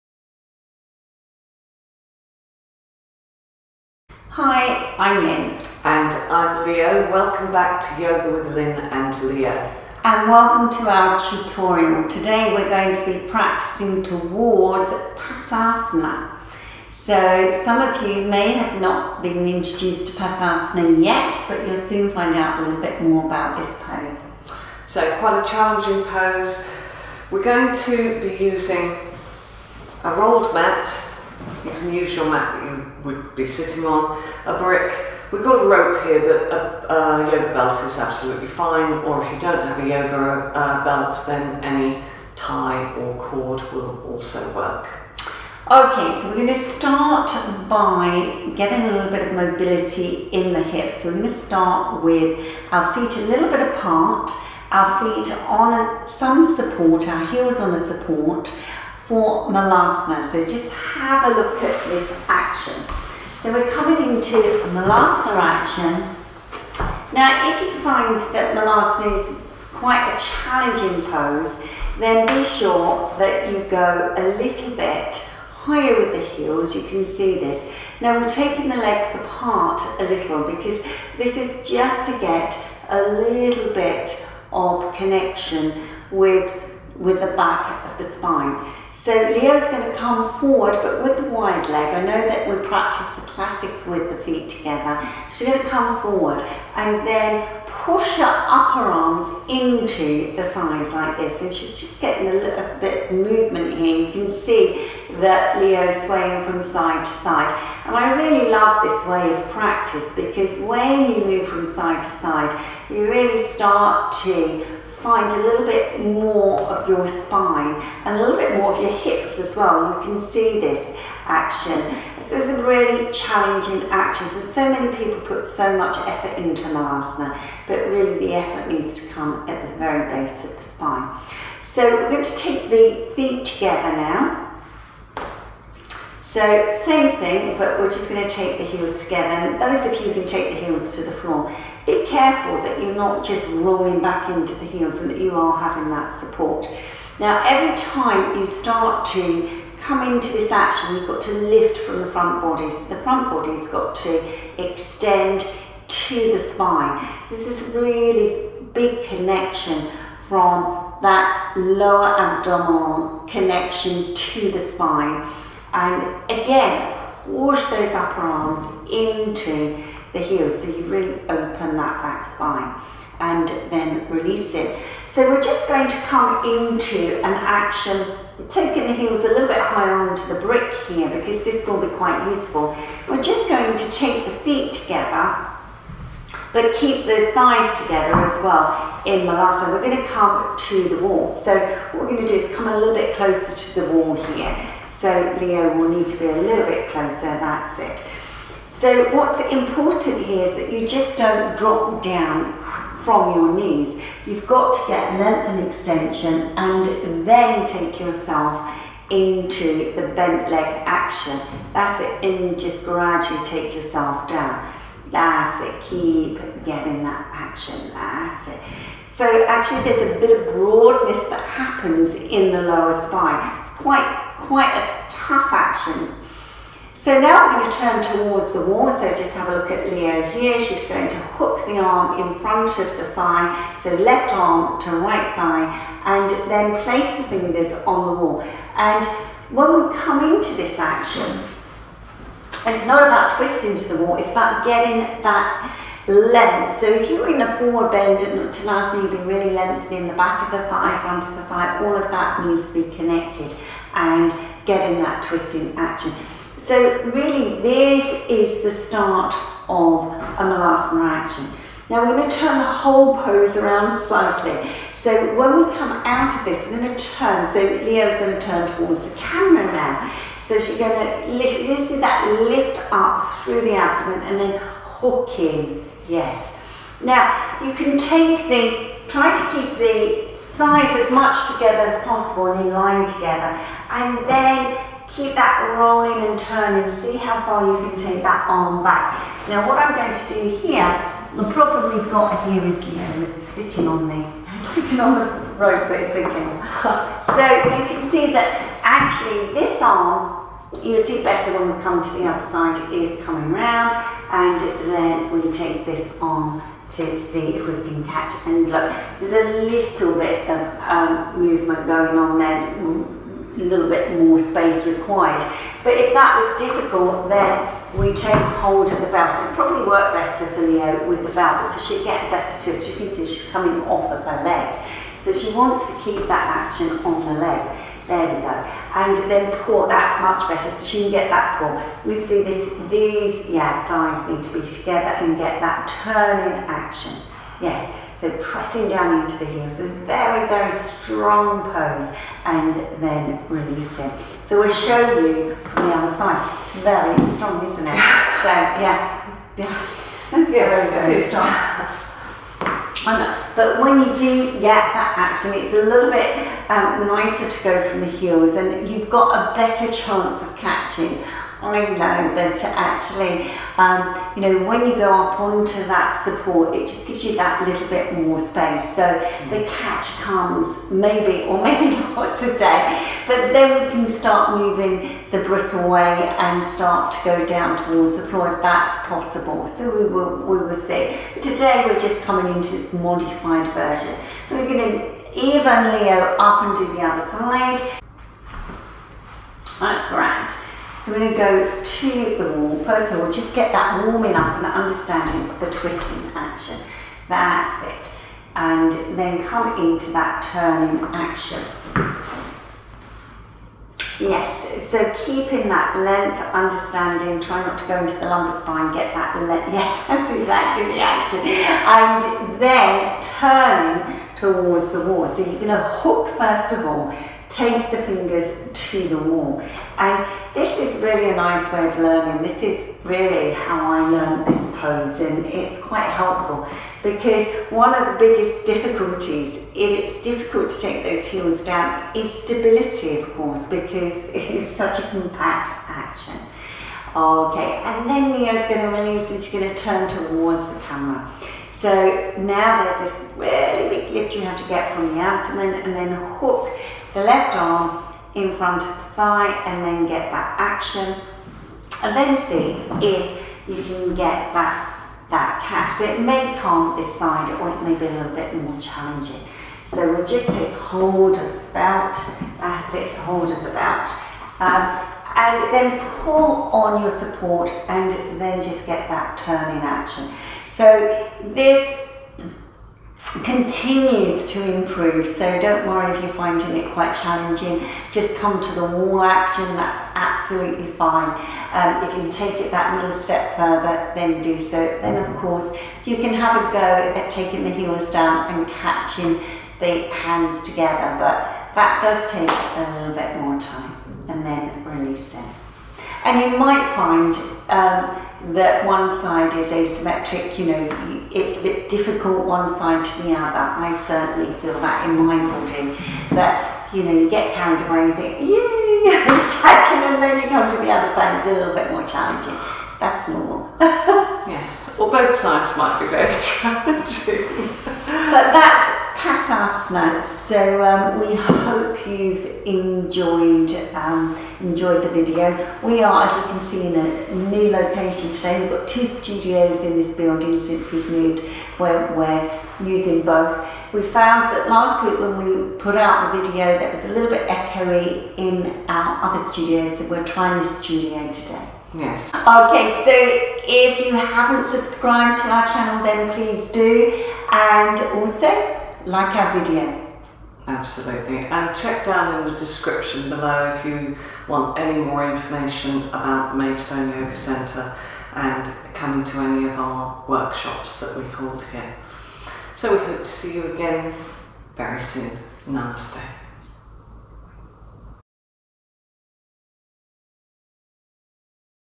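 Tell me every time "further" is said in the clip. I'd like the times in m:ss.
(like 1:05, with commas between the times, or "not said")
8:03.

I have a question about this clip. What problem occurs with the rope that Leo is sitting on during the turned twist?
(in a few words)
it's sinking.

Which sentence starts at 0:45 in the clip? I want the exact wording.
Okay, so we're going to start by getting a little bit of mobility in the hips.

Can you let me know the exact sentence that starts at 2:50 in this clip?
So you really open that back spine and then release it.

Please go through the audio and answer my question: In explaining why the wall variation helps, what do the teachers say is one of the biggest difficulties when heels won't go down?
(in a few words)
stability.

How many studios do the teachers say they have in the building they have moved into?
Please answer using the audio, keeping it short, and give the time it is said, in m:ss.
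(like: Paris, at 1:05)
2, at 8:48.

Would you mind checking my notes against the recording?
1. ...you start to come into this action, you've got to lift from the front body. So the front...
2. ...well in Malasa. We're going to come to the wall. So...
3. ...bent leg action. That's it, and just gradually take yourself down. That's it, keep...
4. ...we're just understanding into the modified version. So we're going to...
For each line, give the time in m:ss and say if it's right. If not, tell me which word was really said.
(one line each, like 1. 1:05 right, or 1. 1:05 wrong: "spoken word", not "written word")
1. 2:28 right
2. 3:08 right
3. 3:30 right
4. 6:21 wrong: "coming", not "understanding".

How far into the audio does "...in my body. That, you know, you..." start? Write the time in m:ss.
8:25.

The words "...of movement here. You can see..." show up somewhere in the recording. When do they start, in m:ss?
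1:43.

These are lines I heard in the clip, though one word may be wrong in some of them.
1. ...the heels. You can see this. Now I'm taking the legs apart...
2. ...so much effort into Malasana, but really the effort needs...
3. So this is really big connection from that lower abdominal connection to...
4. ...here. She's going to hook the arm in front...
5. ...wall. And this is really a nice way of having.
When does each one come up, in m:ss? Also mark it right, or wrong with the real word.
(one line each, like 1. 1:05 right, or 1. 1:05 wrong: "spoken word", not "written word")
1. 1:16 right
2. 2:05 right
3. 2:37 right
4. 3:50 right
5. 6:59 wrong: "learning", not "having".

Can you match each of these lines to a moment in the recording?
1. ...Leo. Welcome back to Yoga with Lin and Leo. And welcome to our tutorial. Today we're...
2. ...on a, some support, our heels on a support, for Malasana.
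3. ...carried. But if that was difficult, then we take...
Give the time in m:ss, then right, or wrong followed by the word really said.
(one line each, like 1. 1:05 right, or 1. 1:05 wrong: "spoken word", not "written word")
1. 0:06 right
2. 0:55 right
3. 5:14 wrong: "required", not "carried".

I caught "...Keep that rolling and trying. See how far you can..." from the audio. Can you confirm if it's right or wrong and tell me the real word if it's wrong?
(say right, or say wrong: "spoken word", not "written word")
wrong: "turning", not "trying".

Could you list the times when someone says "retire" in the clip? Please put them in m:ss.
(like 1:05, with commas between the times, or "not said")
not said.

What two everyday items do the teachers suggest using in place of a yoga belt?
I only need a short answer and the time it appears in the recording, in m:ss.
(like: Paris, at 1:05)
tie or cord, at 0:41.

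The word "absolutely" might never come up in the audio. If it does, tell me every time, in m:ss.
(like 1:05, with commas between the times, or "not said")
0:37, 8:00, 9:10.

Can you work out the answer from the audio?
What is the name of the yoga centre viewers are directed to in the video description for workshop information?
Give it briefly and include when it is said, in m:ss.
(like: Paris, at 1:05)
Maidstone Yoga Centre, at 9:16.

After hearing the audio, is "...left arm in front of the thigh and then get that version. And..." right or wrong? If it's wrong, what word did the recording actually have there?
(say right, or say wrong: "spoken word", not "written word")
wrong: "action", not "version".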